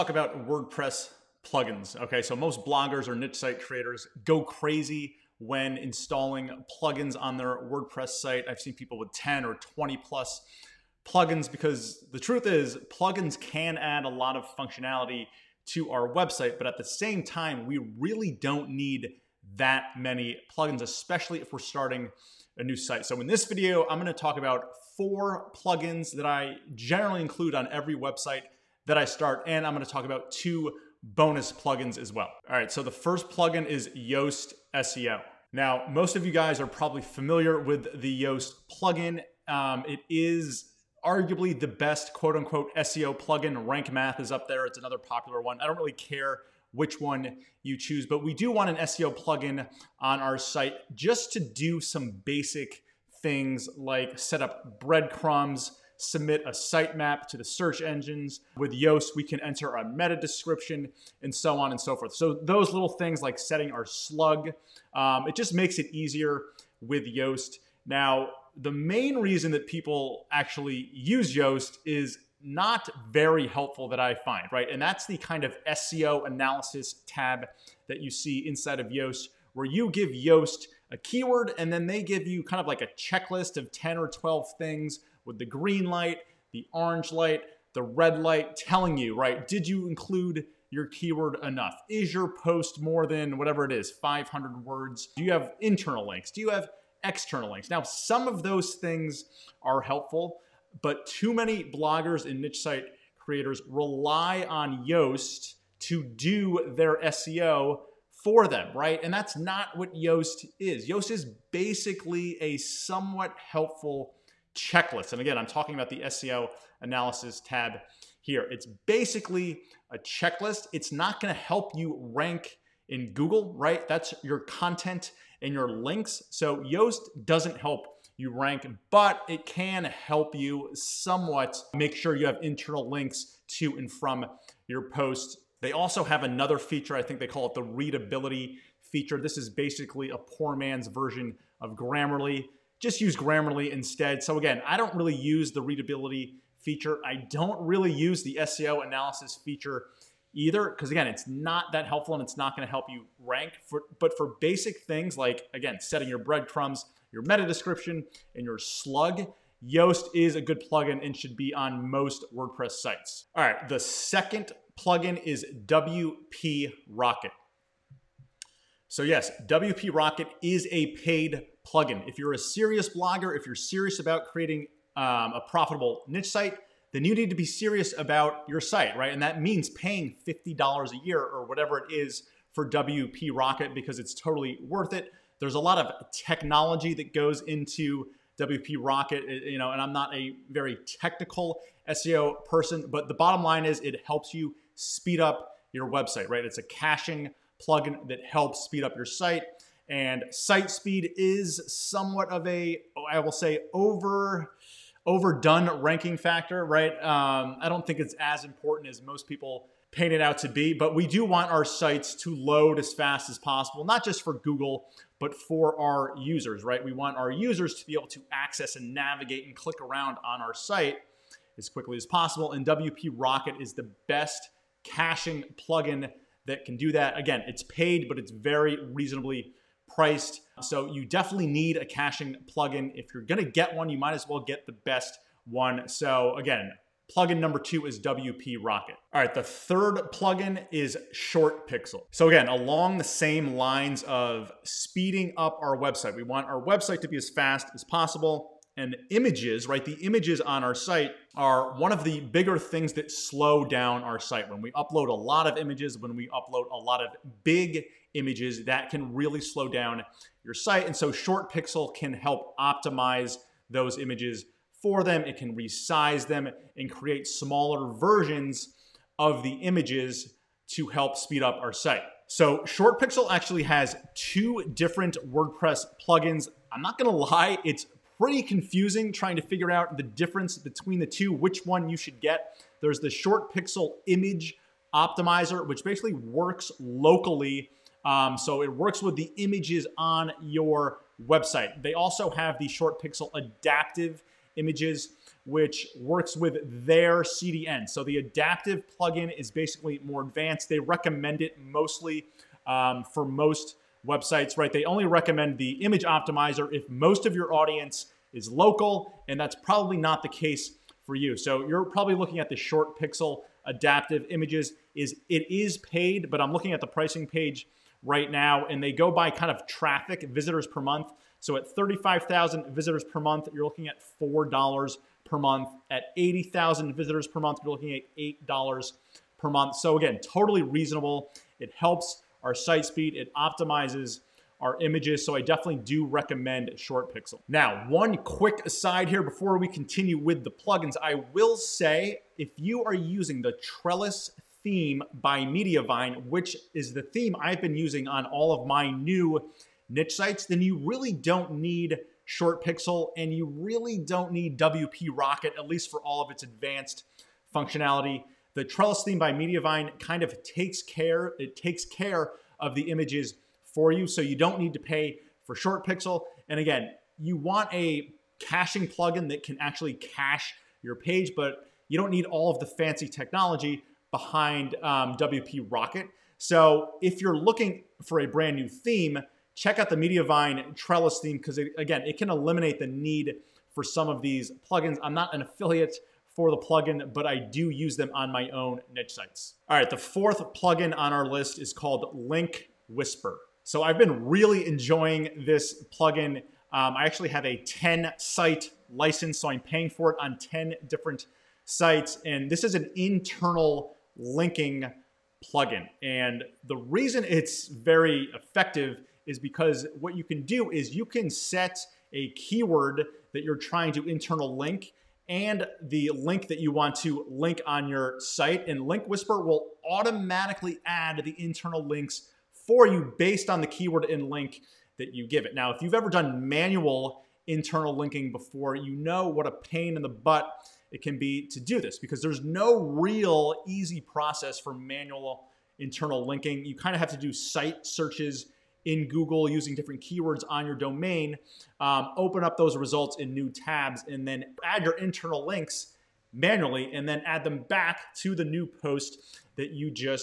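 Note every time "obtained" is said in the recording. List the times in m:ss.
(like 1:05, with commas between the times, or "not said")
not said.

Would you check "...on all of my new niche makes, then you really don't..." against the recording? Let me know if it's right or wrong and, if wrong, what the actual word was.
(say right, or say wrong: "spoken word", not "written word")
wrong: "sites", not "makes".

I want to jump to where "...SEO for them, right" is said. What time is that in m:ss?
1:47.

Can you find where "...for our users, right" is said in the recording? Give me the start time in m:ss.
3:35.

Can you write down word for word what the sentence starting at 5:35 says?
So I definitely do recommend Short Pixel.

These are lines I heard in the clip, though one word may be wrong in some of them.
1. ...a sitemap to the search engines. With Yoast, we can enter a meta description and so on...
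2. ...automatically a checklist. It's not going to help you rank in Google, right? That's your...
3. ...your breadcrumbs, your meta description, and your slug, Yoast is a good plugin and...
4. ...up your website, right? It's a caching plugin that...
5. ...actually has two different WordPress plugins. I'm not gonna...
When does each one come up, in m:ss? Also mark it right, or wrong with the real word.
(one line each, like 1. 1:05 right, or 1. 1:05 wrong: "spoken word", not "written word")
1. 0:56 right
2. 1:58 wrong: "basically", not "automatically"
3. 2:36 right
4. 3:15 right
5. 4:33 right.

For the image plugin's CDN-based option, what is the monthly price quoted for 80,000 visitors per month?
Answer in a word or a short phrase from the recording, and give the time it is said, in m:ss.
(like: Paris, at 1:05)
$8, at 5:28.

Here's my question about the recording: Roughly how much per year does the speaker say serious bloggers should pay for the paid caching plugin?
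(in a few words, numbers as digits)
$50.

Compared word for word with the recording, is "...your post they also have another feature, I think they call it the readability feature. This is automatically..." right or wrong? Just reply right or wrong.
wrong.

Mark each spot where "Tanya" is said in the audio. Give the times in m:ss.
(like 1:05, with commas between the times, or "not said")
not said.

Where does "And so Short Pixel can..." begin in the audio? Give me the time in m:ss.
4:20.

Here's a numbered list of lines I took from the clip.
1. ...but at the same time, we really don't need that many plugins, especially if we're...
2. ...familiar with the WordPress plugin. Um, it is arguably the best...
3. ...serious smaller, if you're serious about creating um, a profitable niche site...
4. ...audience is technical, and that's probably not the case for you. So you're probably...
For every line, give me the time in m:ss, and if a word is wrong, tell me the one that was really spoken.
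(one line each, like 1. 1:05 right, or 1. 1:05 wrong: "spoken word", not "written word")
1. 0:16 right
2. 0:37 wrong: "Yoast", not "WordPress"
3. 2:52 wrong: "blogger", not "smaller"
4. 5:07 wrong: "local", not "technical".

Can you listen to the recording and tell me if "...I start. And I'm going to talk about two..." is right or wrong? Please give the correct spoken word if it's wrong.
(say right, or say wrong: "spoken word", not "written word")
right.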